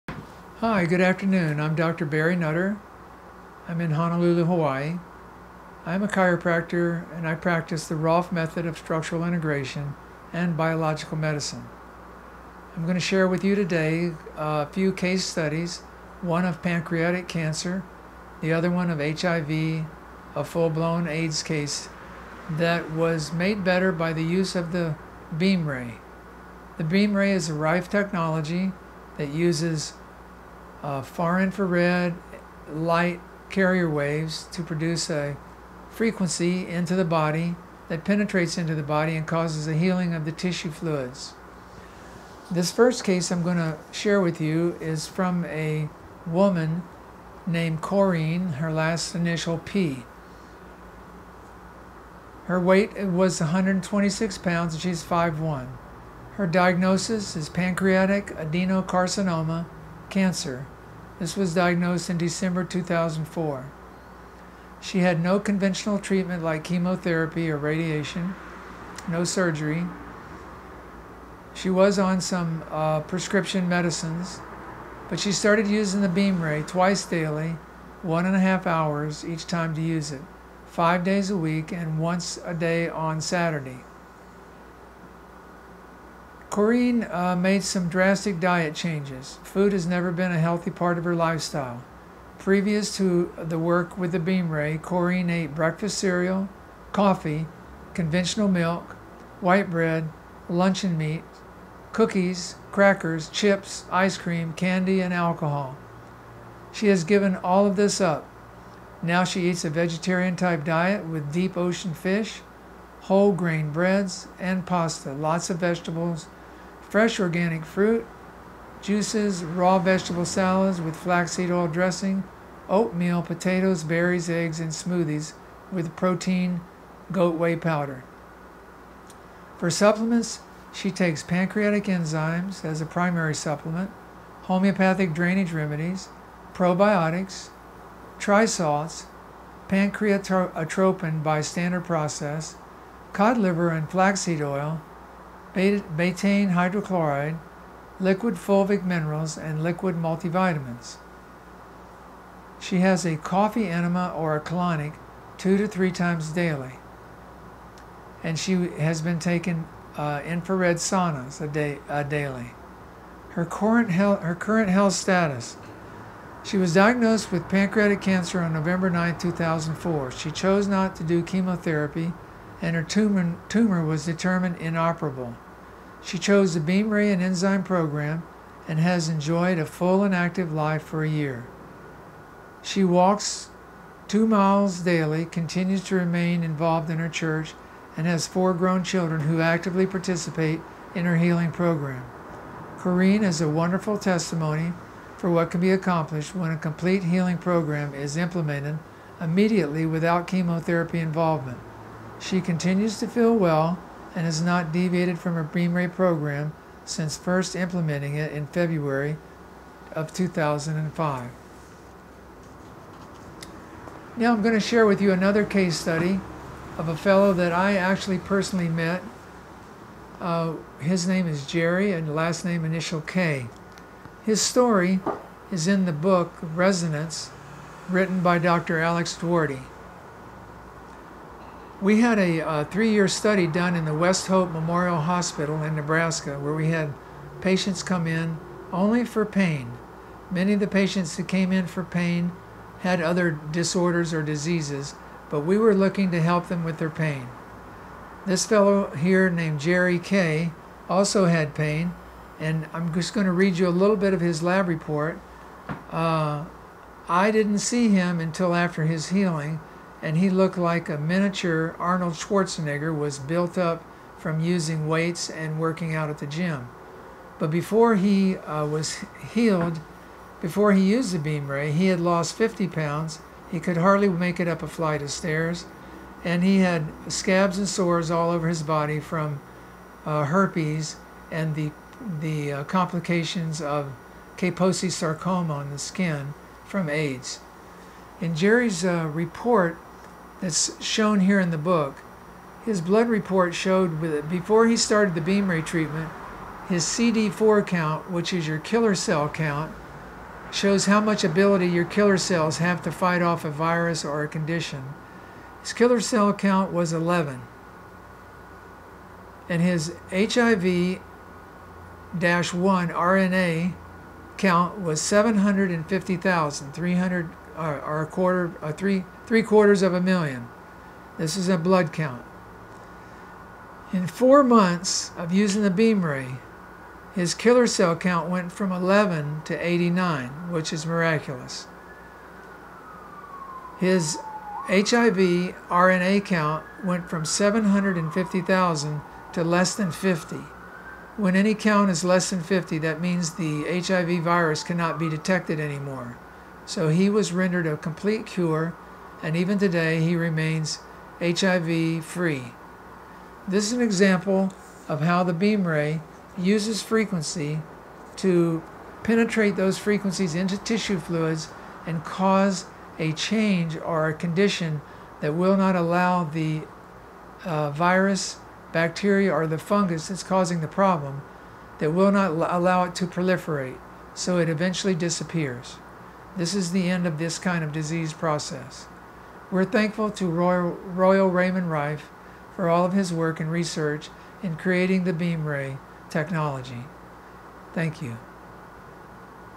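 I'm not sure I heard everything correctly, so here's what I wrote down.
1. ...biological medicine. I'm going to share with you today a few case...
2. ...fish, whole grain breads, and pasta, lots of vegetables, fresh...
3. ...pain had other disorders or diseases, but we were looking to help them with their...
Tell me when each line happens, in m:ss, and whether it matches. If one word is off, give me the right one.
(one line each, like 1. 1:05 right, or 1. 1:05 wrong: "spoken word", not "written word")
1. 0:10 right
2. 1:51 right
3. 4:01 right.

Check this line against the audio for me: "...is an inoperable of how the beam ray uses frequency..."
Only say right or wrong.
wrong.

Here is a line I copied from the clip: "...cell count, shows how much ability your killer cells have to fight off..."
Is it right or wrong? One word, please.
right.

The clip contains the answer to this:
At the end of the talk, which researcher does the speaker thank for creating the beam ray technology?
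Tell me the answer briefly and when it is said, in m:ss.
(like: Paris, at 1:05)
Royal Raymond Rife, at 6:20.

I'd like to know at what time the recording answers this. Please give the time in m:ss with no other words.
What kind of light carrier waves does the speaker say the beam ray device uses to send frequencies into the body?
0:31.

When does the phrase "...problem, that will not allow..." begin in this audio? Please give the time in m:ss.
6:10.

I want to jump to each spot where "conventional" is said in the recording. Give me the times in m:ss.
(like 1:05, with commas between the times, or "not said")
1:05, 1:37.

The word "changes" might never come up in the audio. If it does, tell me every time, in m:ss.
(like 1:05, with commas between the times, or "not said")
1:28, 6:03.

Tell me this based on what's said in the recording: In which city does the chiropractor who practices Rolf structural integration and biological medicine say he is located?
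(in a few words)
Honolulu.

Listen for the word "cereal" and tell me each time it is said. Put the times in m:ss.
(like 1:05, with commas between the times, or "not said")
1:35.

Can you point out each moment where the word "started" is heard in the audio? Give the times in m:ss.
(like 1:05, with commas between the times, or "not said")
1:15, 4:54.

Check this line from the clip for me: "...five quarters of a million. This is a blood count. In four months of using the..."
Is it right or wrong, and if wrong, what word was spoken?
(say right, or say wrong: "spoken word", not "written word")
wrong: "three", not "five".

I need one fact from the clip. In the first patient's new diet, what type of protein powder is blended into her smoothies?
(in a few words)
goat whey.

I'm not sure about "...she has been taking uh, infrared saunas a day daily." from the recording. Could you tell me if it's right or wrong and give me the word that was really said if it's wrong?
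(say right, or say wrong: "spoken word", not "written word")
right.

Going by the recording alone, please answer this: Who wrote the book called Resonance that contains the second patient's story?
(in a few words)
Dr. Alex Duarte.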